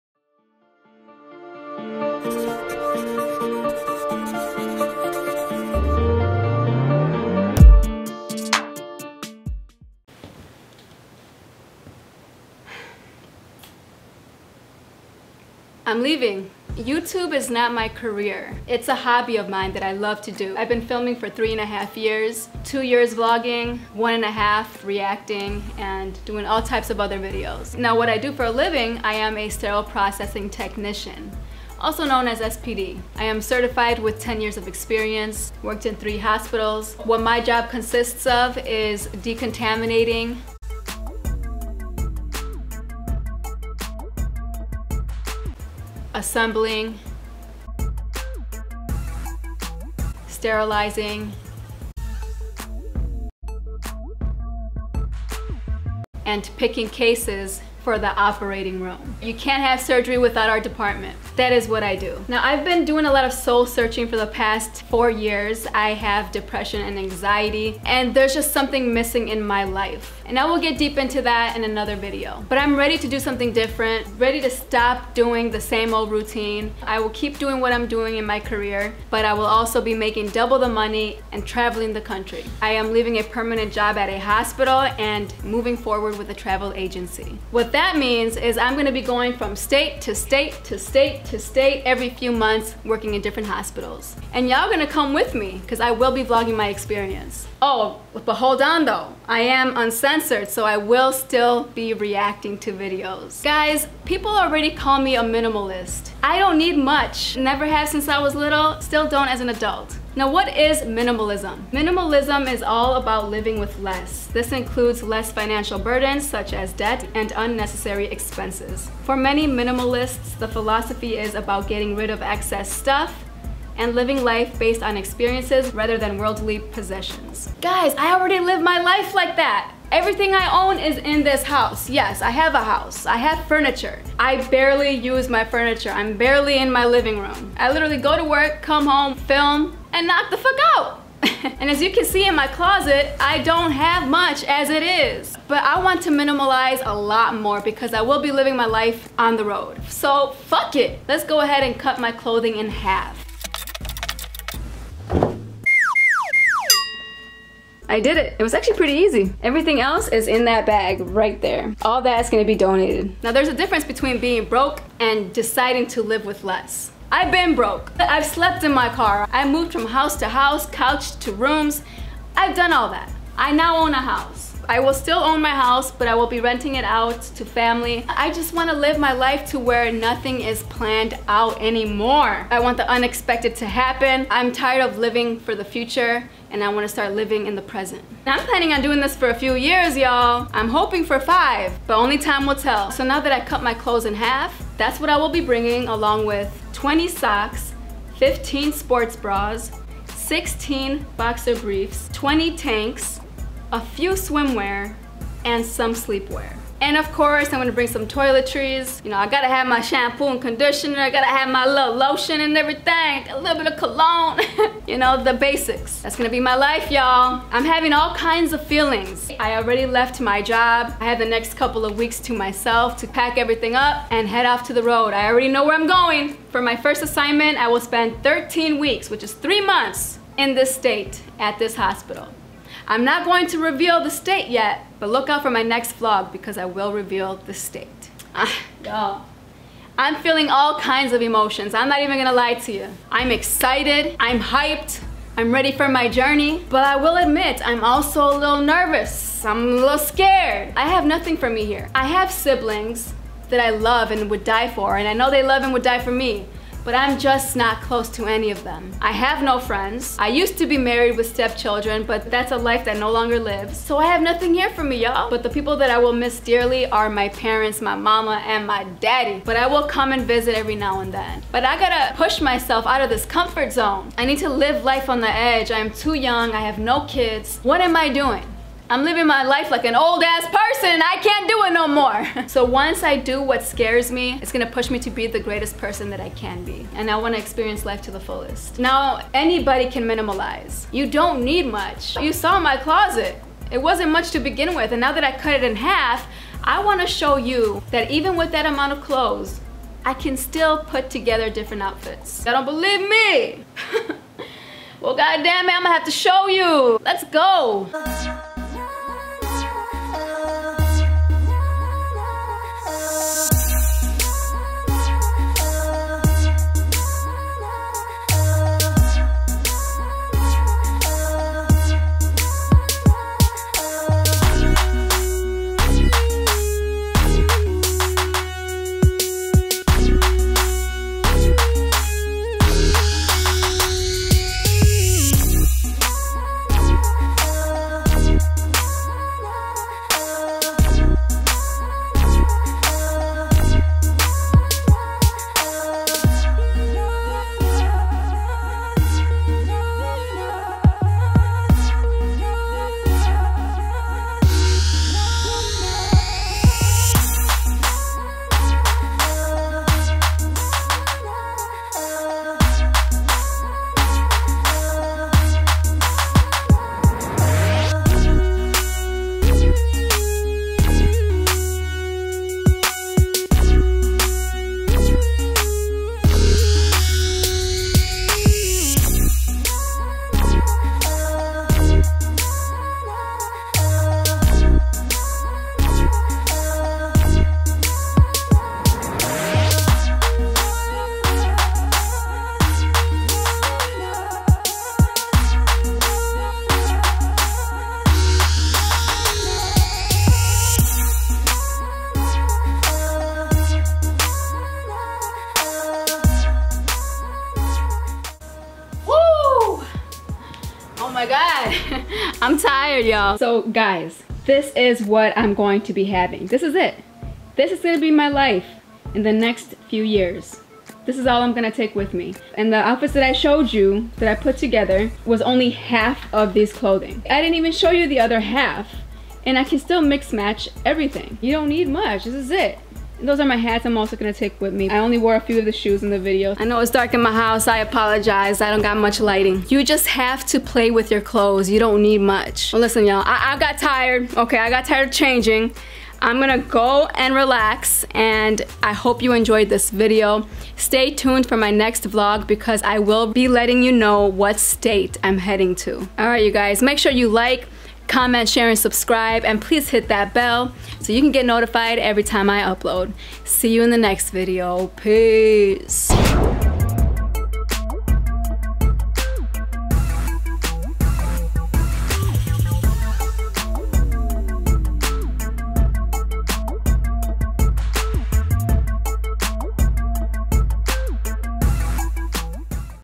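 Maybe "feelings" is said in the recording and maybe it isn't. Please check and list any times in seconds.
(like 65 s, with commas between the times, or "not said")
218 s, 240 s.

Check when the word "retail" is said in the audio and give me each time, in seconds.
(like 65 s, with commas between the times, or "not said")
not said.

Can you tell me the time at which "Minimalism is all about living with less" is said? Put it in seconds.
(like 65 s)
111 s.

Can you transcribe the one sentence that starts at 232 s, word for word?
I'm not going to reveal the state yet, but look out for my next vlog because I will reveal the state.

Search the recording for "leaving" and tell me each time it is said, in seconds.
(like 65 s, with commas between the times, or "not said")
16 s, 82 s.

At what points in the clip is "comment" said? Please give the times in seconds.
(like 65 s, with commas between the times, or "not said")
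458 s.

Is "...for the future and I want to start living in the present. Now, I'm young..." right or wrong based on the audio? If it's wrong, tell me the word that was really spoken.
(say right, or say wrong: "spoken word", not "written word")
wrong: "planning", not "young".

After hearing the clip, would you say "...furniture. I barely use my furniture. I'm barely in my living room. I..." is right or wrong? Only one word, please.
right.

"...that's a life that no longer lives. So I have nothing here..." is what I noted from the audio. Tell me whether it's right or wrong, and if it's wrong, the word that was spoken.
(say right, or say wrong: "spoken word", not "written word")
right.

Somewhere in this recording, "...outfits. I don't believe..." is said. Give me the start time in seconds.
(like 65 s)
301 s.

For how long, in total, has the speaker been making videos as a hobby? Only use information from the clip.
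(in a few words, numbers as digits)
3.5 years.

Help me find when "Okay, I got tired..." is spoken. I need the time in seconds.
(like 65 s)
444 s.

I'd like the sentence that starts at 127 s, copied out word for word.
Guys, I already live my life like that.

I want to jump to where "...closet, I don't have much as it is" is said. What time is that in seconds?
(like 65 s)
142 s.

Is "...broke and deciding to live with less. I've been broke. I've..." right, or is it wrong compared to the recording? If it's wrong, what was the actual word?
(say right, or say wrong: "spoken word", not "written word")
right.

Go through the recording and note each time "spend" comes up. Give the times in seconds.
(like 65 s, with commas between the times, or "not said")
227 s.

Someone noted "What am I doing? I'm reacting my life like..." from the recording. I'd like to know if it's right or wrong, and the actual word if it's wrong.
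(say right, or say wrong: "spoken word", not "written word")
wrong: "living", not "reacting".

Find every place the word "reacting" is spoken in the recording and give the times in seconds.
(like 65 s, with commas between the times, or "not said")
24 s, 101 s.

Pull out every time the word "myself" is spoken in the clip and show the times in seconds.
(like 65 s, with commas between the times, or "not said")
222 s, 272 s.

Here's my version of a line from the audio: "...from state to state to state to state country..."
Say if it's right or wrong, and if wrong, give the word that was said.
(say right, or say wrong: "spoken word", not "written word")
wrong: "every", not "country".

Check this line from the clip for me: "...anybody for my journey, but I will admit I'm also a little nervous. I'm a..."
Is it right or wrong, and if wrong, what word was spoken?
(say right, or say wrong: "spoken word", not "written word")
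wrong: "ready", not "anybody".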